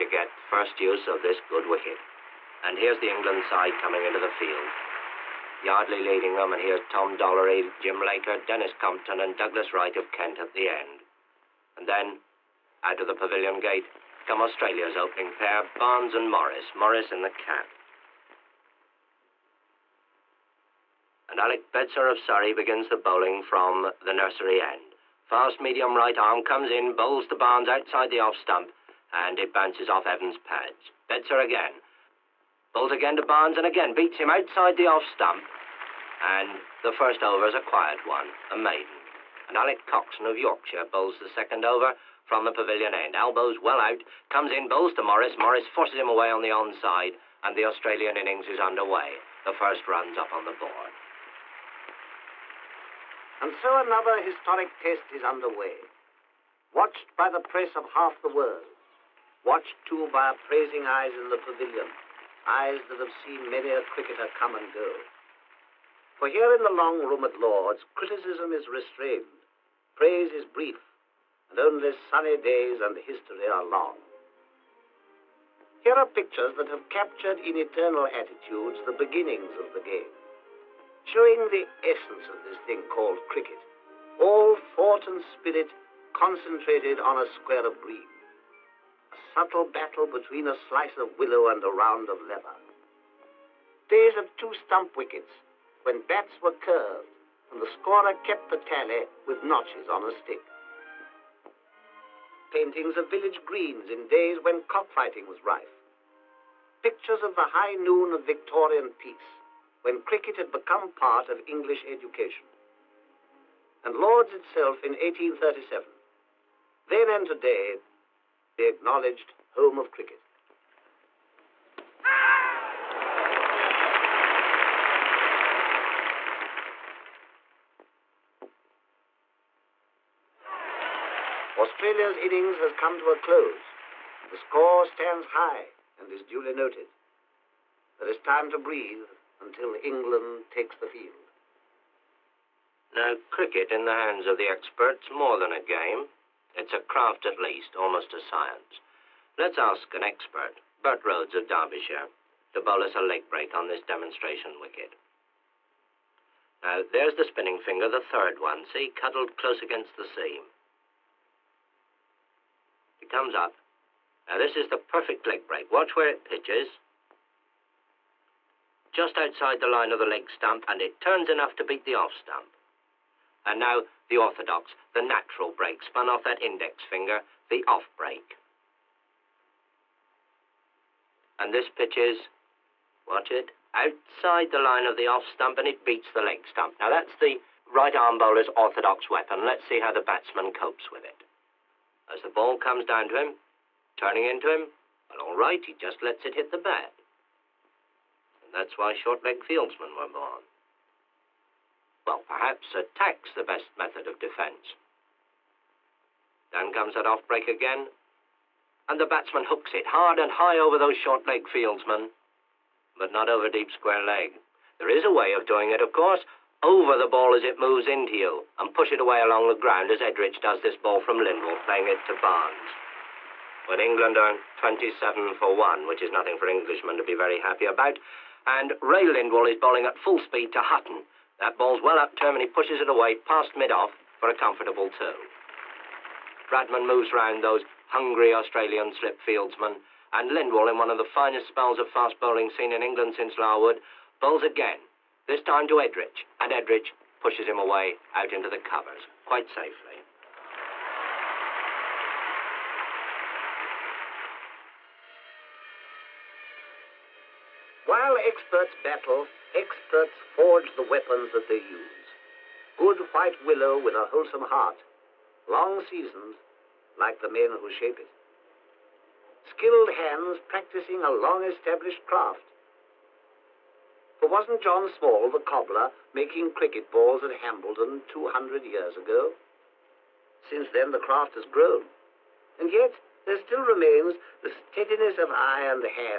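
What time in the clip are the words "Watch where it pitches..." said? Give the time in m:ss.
2:45.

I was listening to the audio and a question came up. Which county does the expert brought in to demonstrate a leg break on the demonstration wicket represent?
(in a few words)
Derbyshire.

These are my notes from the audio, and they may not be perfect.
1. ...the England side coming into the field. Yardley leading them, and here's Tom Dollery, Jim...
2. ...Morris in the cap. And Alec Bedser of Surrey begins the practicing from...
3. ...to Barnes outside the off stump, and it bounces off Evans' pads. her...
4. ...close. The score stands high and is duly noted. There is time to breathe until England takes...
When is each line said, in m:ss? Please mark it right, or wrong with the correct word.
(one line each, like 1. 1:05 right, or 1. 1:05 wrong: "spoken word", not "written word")
1. 0:02 right
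2. 0:16 wrong: "bowling", not "practicing"
3. 0:27 right
4. 2:13 right.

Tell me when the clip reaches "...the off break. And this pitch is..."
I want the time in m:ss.
2:57.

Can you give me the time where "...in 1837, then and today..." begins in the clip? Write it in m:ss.
1:54.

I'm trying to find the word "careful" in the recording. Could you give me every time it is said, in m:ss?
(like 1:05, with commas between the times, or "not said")
not said.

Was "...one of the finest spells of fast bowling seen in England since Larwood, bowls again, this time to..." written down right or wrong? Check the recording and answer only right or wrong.
right.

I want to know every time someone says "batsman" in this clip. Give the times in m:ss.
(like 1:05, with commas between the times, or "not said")
3:10, 3:29.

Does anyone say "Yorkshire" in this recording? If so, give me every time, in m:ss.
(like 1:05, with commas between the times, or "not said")
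0:40.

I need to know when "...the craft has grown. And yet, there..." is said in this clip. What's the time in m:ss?
4:40.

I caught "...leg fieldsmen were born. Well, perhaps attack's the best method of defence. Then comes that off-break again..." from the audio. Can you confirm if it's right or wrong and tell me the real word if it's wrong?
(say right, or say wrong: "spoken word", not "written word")
right.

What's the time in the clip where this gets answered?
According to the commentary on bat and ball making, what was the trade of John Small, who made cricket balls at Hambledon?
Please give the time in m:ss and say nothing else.
4:35.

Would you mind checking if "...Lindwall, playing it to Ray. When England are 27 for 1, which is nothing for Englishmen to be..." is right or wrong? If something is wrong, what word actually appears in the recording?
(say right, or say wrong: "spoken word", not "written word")
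wrong: "Barnes", not "Ray".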